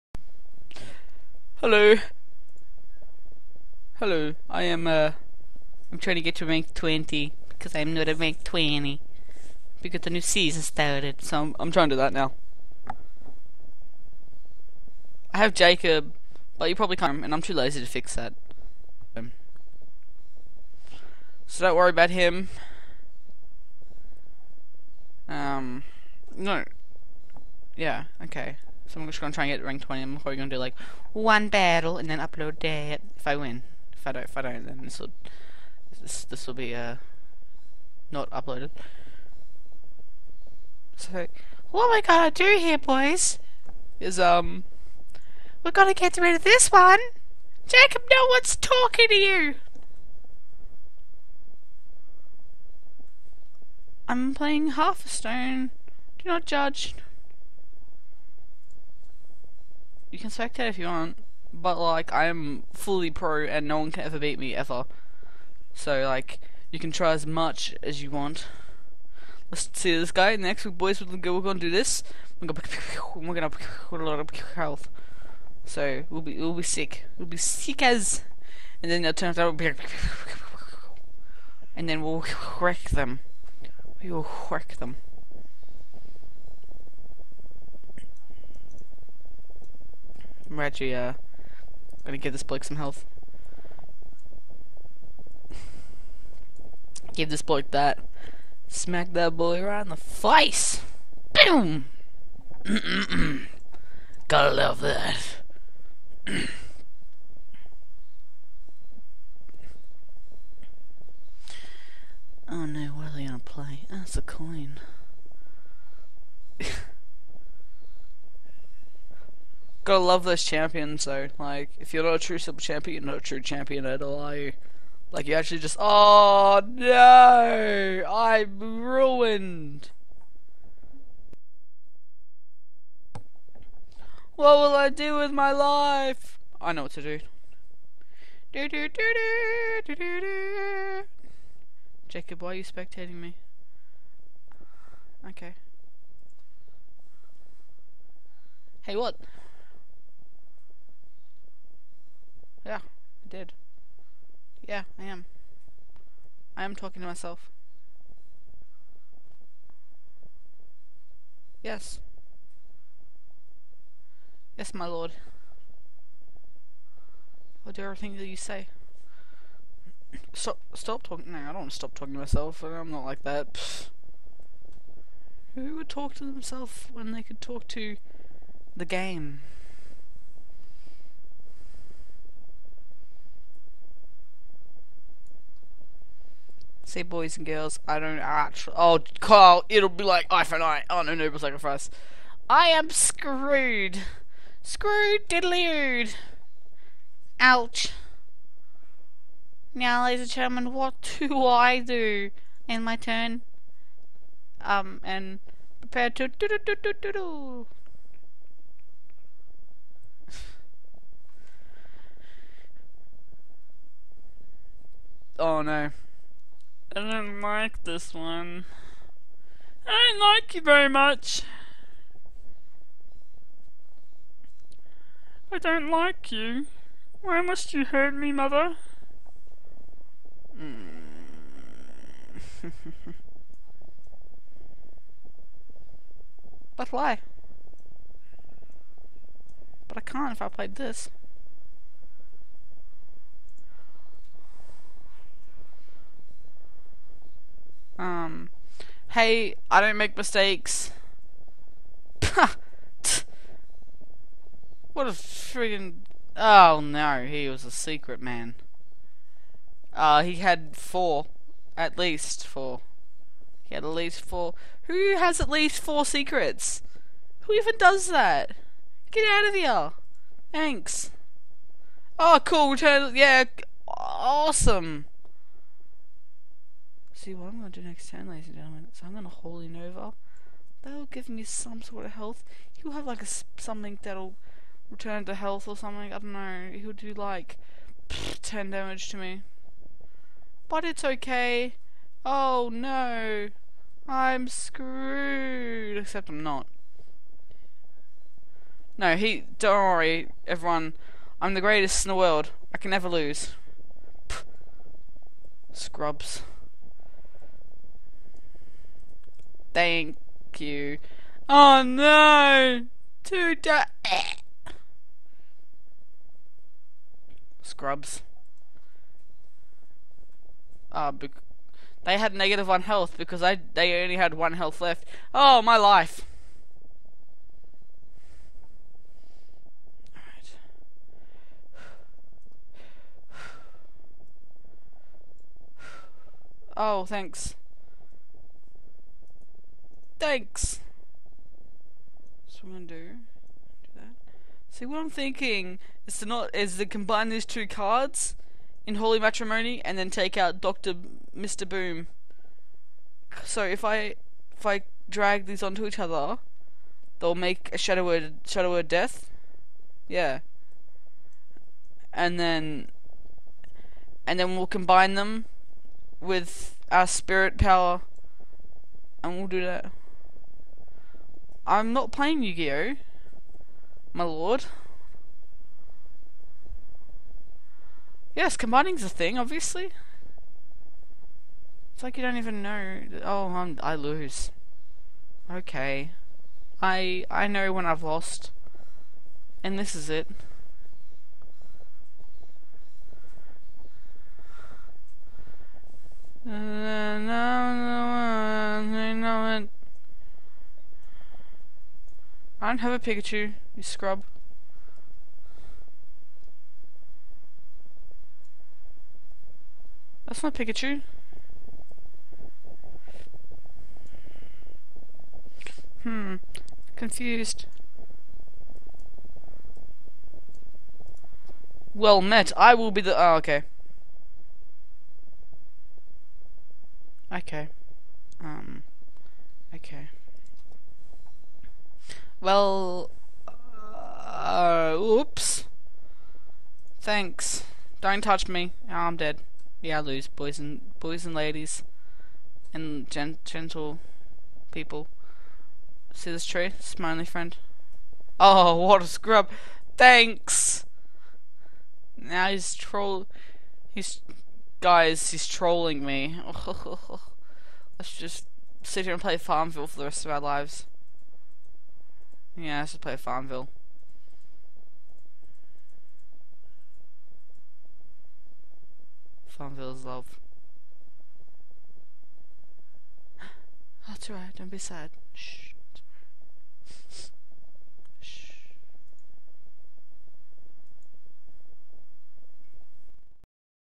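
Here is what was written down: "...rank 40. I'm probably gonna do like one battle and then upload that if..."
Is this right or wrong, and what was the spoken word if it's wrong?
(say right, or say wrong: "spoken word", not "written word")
wrong: "20", not "40".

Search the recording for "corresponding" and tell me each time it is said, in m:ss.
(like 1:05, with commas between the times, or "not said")
not said.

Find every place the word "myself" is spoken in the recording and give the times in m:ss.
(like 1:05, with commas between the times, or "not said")
2:37, 2:52.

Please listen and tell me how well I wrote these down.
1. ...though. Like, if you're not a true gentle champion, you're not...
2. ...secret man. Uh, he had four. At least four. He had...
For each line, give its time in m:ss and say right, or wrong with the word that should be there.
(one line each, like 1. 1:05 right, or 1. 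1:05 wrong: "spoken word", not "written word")
1. 2:01 wrong: "simple", not "gentle"
2. 4:17 right.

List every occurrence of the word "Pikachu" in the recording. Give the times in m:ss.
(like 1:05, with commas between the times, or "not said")
6:42, 6:50.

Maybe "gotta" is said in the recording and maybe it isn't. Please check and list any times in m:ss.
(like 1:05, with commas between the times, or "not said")
0:42, 1:44, 1:59.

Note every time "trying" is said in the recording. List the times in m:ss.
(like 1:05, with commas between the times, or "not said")
0:05, 0:11.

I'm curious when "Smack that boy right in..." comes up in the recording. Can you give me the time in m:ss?
1:38.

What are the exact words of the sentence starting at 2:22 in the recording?
Jacob, why are you spectating me?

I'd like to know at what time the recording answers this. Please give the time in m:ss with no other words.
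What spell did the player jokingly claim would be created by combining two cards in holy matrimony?
5:58.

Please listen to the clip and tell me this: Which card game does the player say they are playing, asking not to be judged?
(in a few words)
Half a Stone.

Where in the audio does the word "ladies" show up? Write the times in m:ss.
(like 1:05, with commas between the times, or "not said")
3:20, 4:38, 7:21.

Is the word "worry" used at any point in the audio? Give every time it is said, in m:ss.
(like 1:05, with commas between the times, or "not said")
0:21, 4:59.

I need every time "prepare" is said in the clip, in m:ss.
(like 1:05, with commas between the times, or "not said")
3:25.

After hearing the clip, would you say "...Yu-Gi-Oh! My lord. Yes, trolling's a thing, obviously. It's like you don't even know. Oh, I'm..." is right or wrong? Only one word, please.
wrong.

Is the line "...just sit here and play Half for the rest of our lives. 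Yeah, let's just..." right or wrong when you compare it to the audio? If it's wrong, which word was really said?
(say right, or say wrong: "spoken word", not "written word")
wrong: "Farmville", not "Half".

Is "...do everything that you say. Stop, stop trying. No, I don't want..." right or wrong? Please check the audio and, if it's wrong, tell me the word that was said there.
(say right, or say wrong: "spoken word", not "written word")
wrong: "talking", not "trying".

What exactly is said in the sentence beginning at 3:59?
But I can't if I played this.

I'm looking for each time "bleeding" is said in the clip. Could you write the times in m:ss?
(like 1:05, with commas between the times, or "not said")
not said.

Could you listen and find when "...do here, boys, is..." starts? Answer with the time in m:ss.
0:42.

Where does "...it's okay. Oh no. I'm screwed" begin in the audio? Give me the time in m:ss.
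4:50.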